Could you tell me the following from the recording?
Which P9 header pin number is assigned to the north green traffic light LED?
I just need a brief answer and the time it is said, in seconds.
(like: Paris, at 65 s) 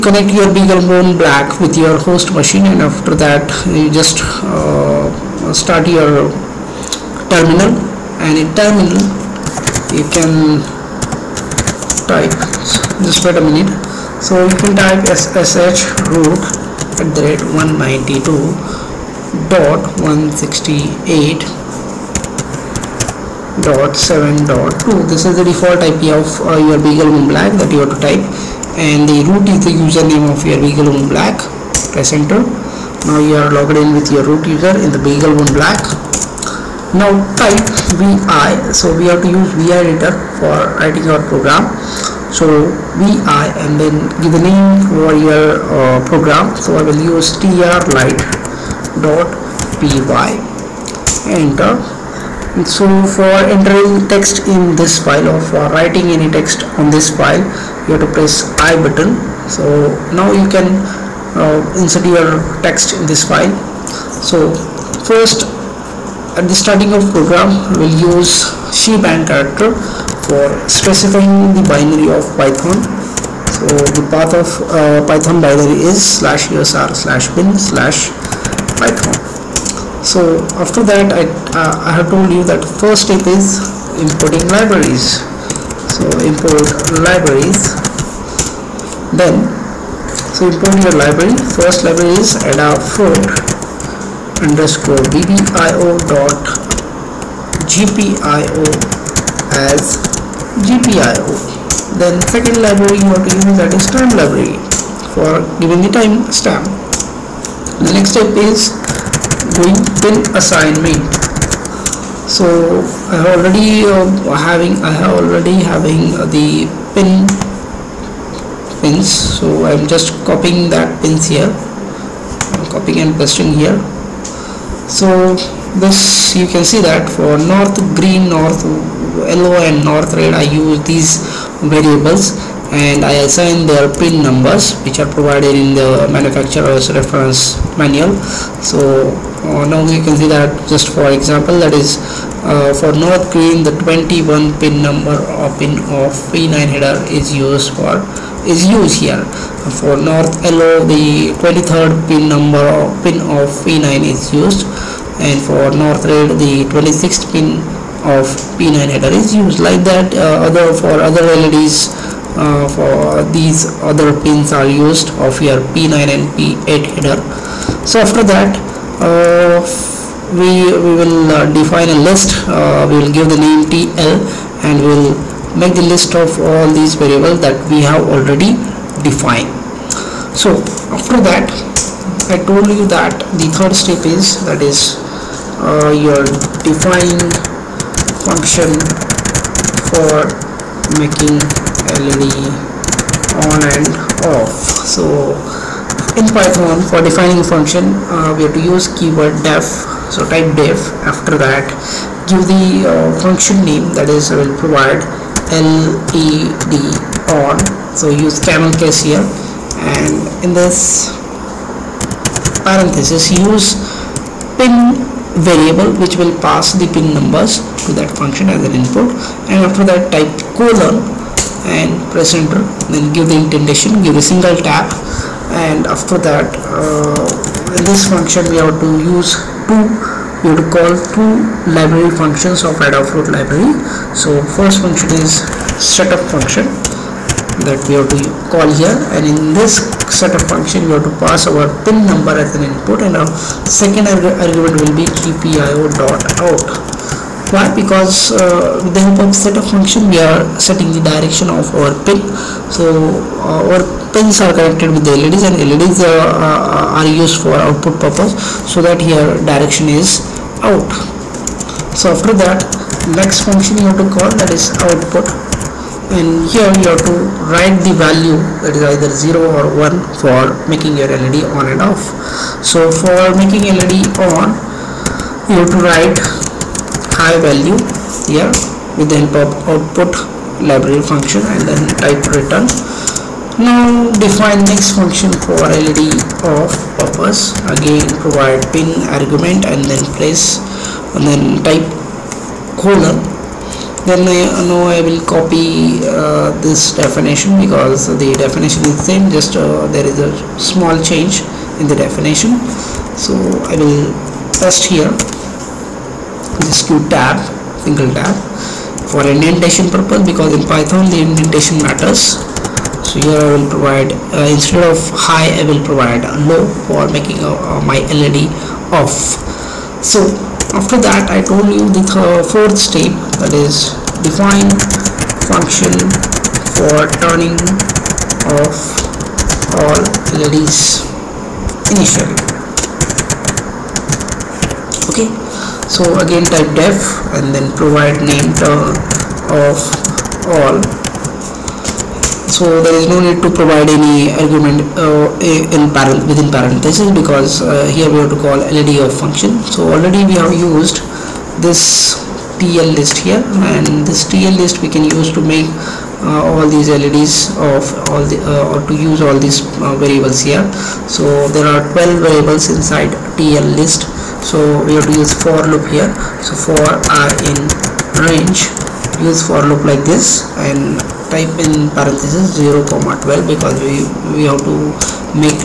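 21, at 143 s.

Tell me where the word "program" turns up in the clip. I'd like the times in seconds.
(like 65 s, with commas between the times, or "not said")
41 s, 46 s, 67 s.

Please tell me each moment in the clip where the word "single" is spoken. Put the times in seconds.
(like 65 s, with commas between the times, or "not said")
224 s, 307 s.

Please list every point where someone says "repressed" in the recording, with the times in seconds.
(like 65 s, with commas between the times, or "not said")
not said.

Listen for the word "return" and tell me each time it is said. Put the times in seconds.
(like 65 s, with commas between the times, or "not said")
282 s.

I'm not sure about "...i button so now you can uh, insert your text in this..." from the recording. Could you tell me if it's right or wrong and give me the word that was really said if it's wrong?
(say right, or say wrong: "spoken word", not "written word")
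right.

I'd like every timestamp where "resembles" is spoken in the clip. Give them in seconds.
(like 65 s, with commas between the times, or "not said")
not said.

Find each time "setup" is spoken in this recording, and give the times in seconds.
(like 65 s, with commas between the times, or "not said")
235 s, 240 s, 249 s.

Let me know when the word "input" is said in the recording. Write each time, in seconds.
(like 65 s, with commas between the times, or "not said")
218 s, 242 s.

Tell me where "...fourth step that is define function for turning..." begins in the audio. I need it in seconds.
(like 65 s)
322 s.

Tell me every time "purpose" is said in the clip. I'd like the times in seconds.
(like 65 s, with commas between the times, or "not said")
258 s, 287 s, 309 s.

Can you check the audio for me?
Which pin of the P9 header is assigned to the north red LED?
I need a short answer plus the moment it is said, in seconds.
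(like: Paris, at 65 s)
26, at 156 s.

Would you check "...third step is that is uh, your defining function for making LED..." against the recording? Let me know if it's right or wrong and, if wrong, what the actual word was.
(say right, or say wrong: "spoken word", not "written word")
right.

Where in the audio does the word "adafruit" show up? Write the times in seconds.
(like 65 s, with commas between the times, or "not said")
92 s, 232 s.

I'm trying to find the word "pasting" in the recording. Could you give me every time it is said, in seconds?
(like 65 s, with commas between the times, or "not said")
123 s.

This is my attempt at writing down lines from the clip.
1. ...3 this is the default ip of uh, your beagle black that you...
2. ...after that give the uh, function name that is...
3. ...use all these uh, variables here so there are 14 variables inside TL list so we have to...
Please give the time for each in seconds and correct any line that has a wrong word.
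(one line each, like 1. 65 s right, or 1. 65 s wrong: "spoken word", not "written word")
1. 24 s wrong: "2", not "3"
2. 201 s right
3. 359 s wrong: "12", not "14".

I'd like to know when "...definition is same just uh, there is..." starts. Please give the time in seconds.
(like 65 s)
298 s.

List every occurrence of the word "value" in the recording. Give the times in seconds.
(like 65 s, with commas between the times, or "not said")
267 s, 277 s.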